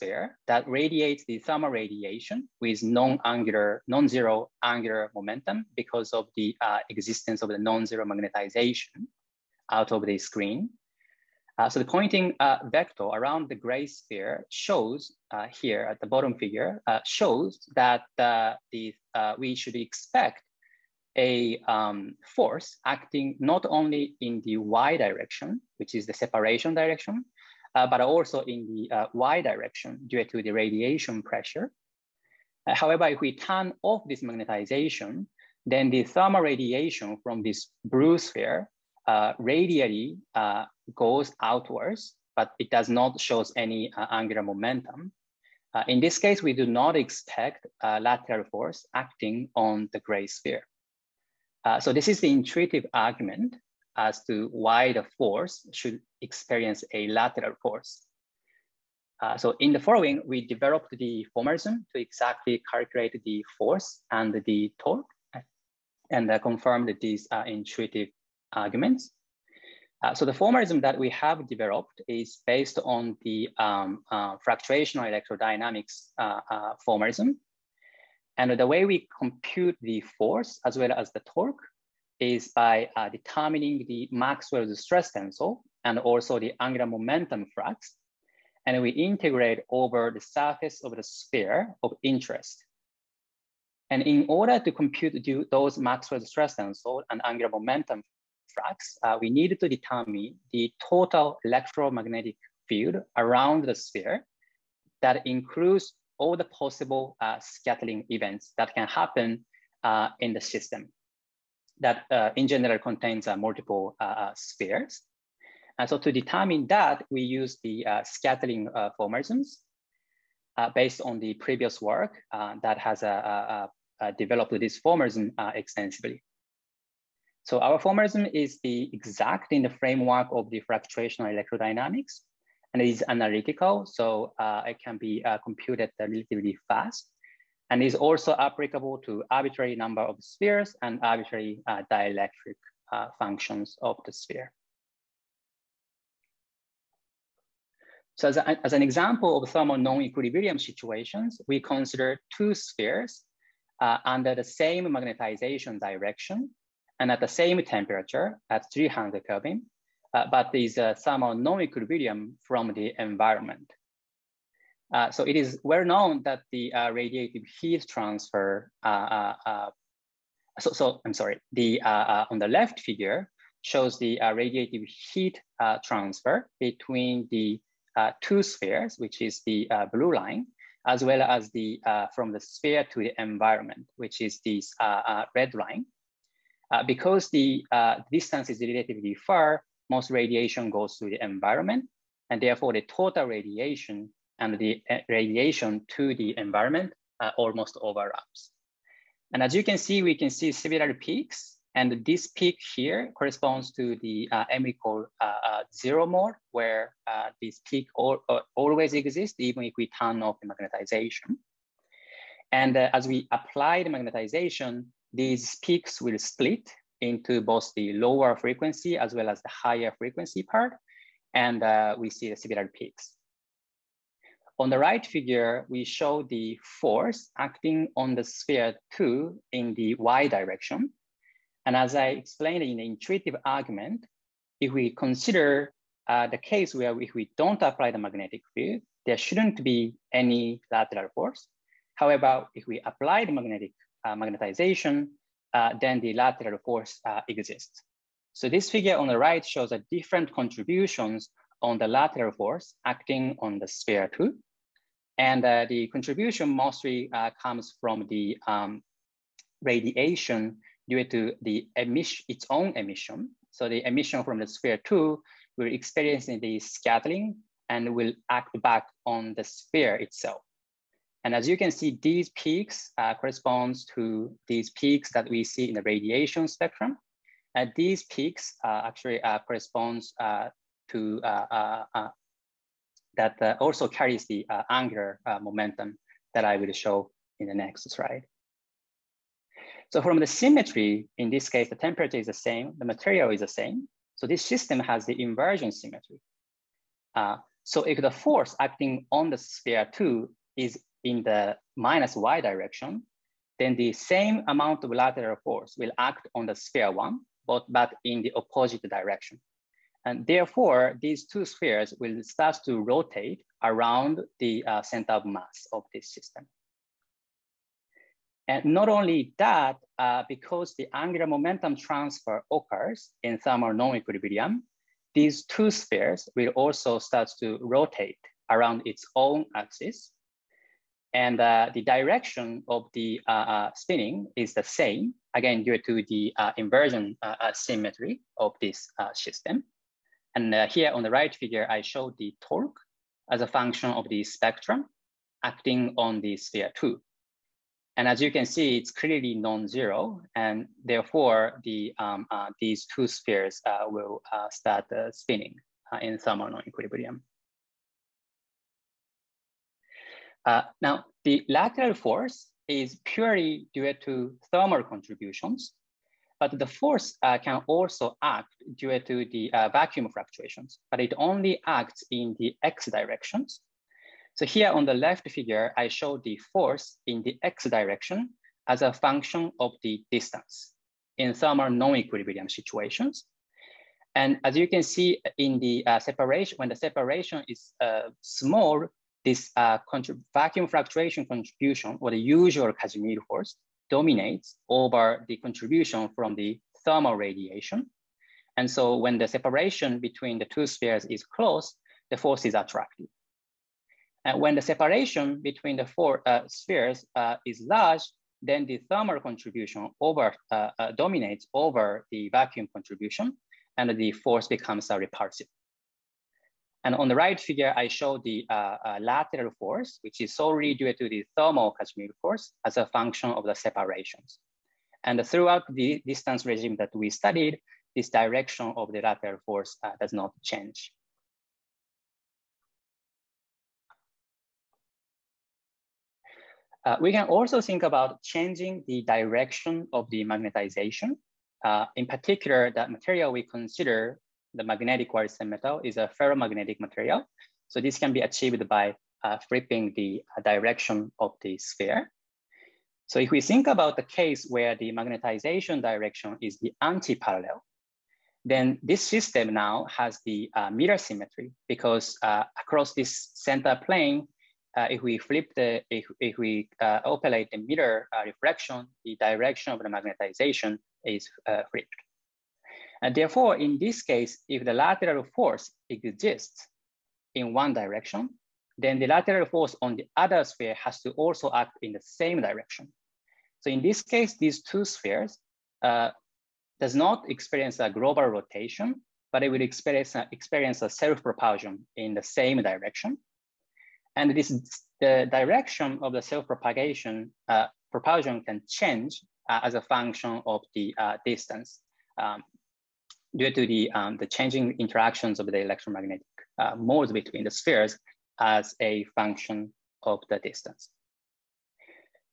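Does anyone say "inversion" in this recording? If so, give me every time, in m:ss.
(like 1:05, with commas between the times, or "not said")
4:55, 5:36.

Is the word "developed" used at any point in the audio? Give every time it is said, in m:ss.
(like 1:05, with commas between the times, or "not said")
1:00, 1:11, 2:04.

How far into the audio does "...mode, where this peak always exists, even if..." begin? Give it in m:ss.
3:26.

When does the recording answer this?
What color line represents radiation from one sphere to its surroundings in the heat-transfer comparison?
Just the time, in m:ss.
3:05.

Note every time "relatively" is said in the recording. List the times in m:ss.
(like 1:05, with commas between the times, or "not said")
2:15, 3:08.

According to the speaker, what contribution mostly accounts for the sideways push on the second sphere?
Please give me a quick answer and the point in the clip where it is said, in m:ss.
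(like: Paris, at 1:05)
Its own emission, at 4:22.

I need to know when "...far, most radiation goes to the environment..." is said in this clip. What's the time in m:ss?
3:09.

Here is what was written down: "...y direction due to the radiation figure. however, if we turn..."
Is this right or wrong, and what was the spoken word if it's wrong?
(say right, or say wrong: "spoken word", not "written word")
wrong: "pressure", not "figure".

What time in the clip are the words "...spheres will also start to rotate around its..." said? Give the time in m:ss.
5:25.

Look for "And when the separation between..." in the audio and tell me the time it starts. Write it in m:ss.
6:44.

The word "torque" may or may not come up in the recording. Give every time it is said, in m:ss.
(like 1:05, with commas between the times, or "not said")
1:04, 1:21, 5:42.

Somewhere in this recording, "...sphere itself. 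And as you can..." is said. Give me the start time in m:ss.
4:29.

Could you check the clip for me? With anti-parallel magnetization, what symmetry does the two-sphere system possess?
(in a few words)
Mirror symmetry.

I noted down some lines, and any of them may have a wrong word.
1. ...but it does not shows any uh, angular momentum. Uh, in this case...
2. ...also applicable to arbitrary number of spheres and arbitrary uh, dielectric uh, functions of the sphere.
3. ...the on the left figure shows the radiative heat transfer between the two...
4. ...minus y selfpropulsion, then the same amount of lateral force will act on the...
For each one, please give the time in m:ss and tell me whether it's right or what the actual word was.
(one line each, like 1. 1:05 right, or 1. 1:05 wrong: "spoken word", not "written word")
1. 0:42 right
2. 2:17 right
3. 2:51 right
4. 5:01 wrong: "direction", not "selfpropulsion".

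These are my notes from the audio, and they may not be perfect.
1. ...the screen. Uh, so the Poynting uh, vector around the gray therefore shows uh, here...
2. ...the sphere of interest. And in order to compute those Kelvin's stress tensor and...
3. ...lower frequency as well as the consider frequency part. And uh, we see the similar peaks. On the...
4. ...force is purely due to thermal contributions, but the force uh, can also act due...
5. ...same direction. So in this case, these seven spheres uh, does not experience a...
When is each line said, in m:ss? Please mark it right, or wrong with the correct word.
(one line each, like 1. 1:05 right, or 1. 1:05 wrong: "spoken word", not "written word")
1. 0:10 wrong: "sphere", not "therefore"
2. 1:30 wrong: "Maxwell", not "Kelvin"
3. 3:37 wrong: "higher", not "consider"
4. 6:01 right
5. 8:01 wrong: "two", not "seven".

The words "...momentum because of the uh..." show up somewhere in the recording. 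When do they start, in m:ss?
0:05.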